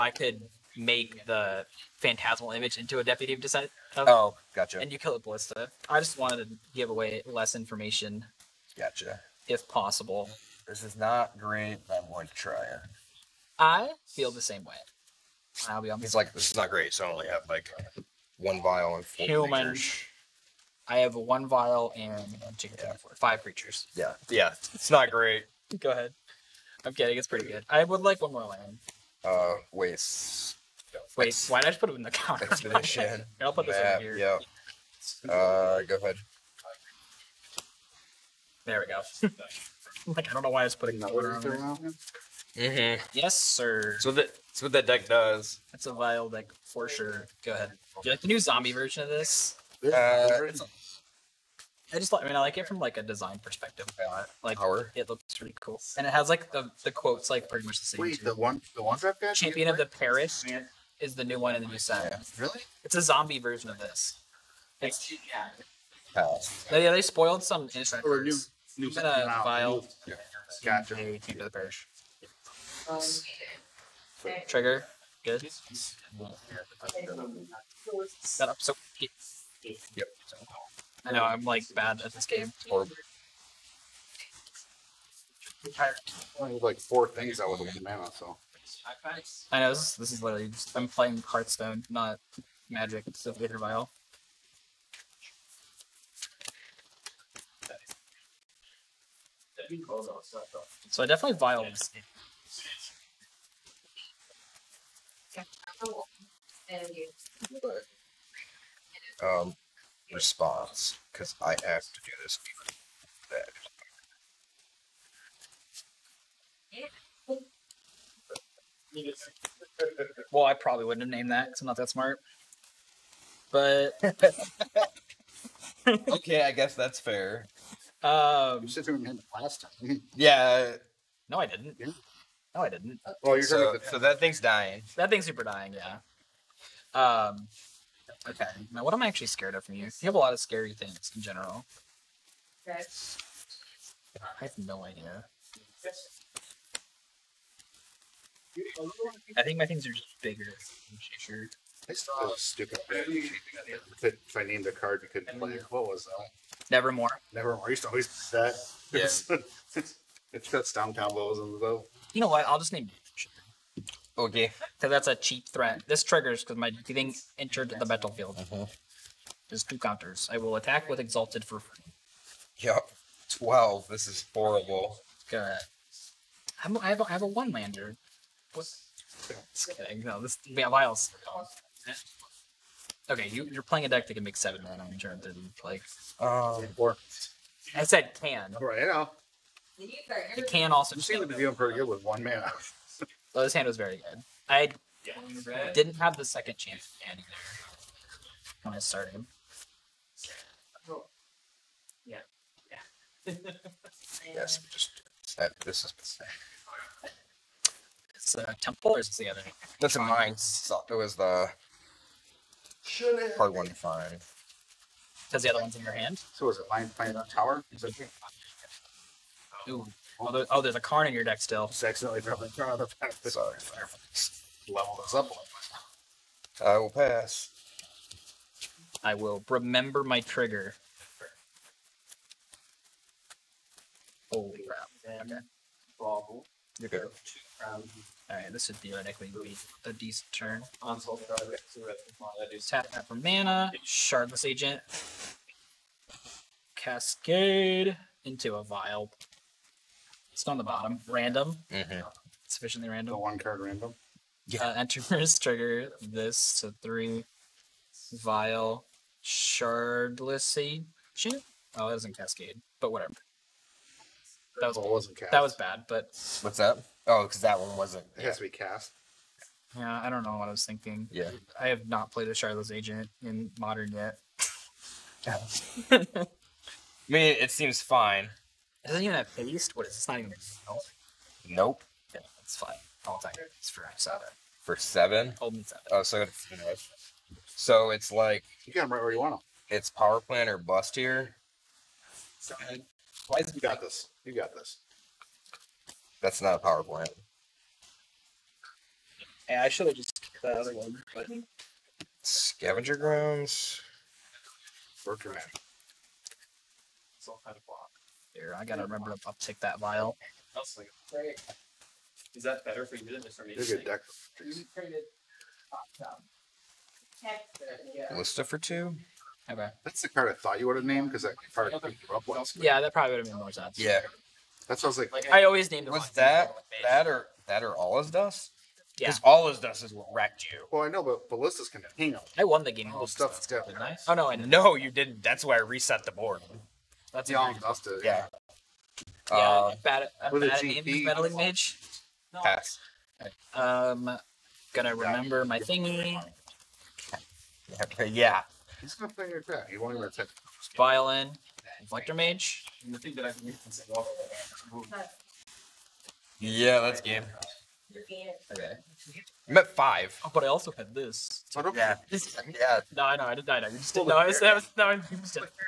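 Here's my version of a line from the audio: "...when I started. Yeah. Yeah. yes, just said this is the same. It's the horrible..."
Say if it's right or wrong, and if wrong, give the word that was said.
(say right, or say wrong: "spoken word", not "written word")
wrong: "temple", not "horrible".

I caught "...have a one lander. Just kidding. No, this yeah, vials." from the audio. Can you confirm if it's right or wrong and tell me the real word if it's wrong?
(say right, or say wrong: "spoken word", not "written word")
right.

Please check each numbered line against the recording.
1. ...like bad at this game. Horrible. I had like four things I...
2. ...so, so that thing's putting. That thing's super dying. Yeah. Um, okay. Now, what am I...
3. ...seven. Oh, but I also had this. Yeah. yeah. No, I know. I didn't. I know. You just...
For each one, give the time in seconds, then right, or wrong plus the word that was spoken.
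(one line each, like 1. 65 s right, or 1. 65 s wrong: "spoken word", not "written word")
1. 81 s right
2. 133 s wrong: "dying", not "putting"
3. 359 s wrong: "five", not "seven".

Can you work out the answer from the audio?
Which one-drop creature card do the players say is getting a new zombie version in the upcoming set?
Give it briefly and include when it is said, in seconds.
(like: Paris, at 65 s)
Champion of the Parish, at 59 s.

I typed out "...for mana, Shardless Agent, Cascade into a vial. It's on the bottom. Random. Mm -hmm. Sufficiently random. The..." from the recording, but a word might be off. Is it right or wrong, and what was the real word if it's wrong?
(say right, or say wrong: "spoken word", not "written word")
right.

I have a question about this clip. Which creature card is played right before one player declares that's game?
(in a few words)
Reflector Mage.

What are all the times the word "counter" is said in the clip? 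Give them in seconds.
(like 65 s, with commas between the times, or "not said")
32 s, 169 s.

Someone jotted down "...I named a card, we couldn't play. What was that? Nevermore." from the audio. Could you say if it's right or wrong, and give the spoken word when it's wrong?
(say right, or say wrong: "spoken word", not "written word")
right.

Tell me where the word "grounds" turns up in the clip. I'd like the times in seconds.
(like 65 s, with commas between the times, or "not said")
302 s.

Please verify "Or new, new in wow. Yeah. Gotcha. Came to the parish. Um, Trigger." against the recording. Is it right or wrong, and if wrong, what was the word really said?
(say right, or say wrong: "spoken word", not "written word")
right.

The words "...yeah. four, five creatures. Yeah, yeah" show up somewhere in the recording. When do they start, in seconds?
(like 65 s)
22 s.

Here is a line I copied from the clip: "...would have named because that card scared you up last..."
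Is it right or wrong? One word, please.
wrong.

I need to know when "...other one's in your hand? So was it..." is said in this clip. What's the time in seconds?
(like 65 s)
215 s.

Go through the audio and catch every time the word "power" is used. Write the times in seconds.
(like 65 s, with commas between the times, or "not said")
54 s, 289 s, 296 s.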